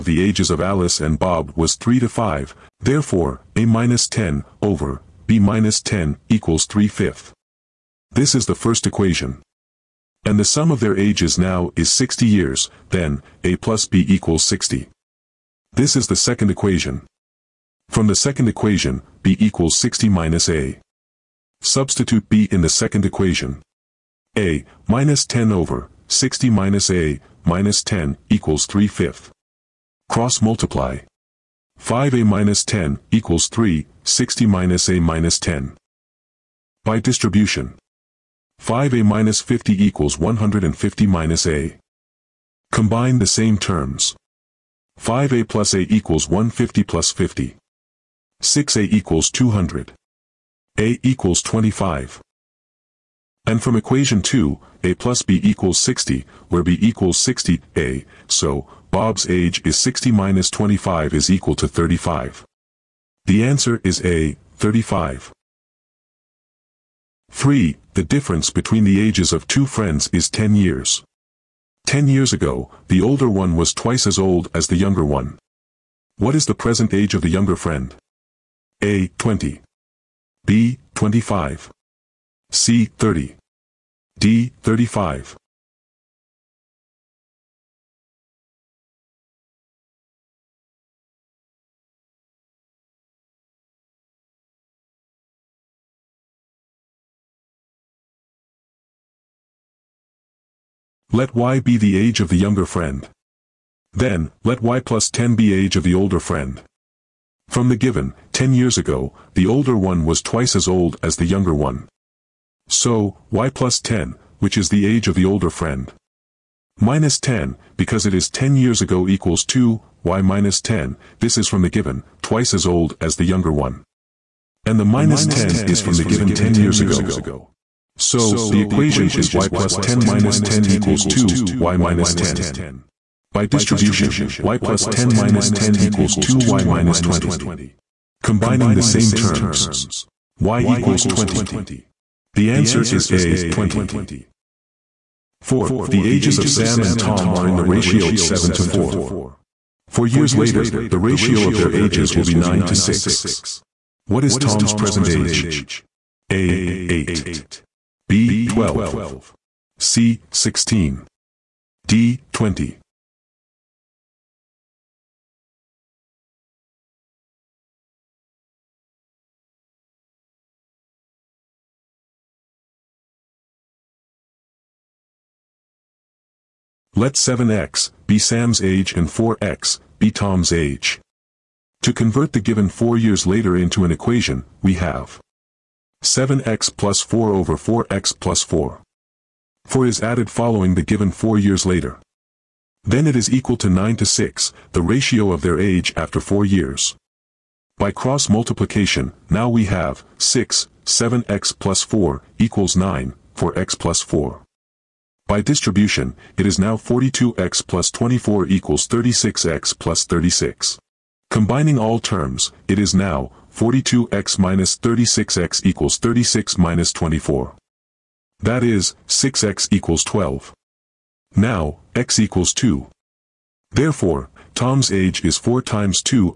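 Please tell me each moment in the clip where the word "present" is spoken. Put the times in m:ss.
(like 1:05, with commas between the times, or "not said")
1:16, 2:34.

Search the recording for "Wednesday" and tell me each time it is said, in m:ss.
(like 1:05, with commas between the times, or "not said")
not said.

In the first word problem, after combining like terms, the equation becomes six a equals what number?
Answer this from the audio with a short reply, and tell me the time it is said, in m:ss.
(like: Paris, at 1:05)
200, at 0:49.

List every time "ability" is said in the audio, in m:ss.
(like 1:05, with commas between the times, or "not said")
not said.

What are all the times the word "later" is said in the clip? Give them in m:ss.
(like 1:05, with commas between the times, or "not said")
2:30, 3:03, 3:11.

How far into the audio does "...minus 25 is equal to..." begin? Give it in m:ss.
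1:00.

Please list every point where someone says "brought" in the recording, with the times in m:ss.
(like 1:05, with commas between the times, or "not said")
not said.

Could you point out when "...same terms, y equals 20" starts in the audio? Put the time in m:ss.
2:18.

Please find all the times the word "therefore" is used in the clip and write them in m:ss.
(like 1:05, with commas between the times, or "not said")
0:02, 3:43.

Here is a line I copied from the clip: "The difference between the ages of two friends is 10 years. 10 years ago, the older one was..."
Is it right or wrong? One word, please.
right.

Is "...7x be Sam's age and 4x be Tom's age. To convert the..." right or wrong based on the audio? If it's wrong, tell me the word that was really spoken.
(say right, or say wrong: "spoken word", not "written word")
right.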